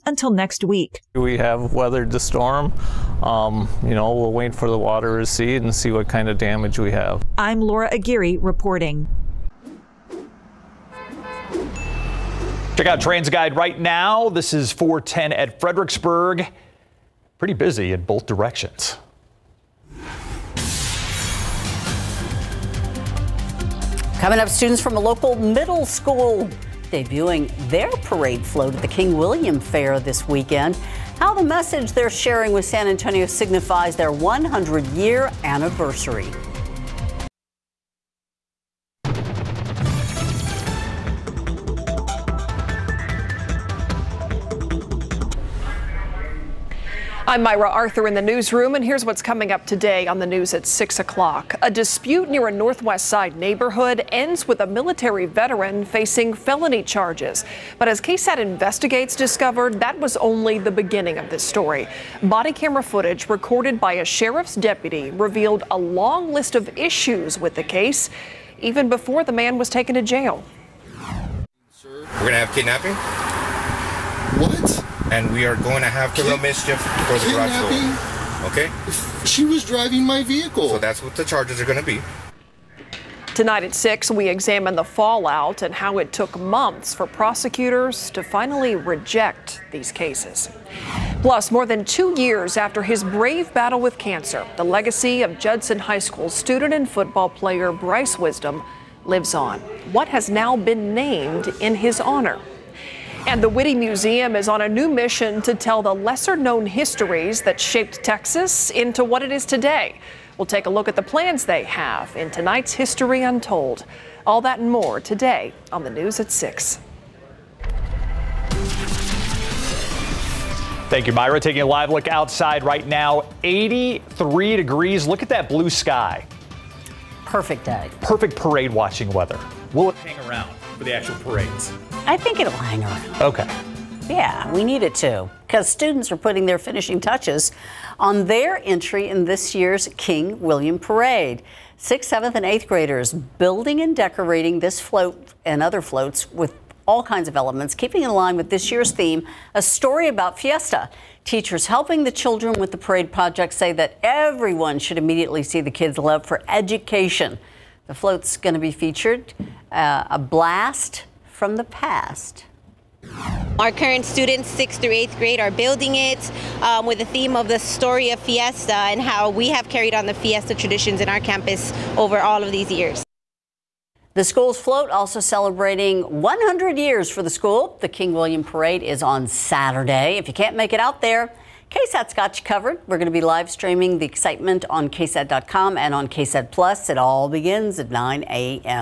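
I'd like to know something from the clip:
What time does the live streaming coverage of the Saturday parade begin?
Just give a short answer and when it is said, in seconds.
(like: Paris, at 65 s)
9 a.m., at 187 s.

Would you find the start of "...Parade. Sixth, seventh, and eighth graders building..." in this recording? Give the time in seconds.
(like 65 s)
140 s.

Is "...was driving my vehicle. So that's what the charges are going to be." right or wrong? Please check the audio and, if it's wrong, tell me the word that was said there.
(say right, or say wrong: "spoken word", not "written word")
right.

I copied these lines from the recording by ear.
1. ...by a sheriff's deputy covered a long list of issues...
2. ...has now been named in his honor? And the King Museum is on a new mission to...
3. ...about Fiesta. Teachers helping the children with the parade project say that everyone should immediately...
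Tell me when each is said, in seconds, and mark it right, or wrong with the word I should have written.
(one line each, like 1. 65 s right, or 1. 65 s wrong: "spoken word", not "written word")
1. 63 s wrong: "revealed", not "covered"
2. 100 s wrong: "Witte", not "King"
3. 150 s right.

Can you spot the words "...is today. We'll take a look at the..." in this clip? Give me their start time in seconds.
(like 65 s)
109 s.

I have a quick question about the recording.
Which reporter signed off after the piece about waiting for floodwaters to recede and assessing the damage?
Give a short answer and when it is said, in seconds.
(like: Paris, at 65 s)
Laura Aguirre, at 7 s.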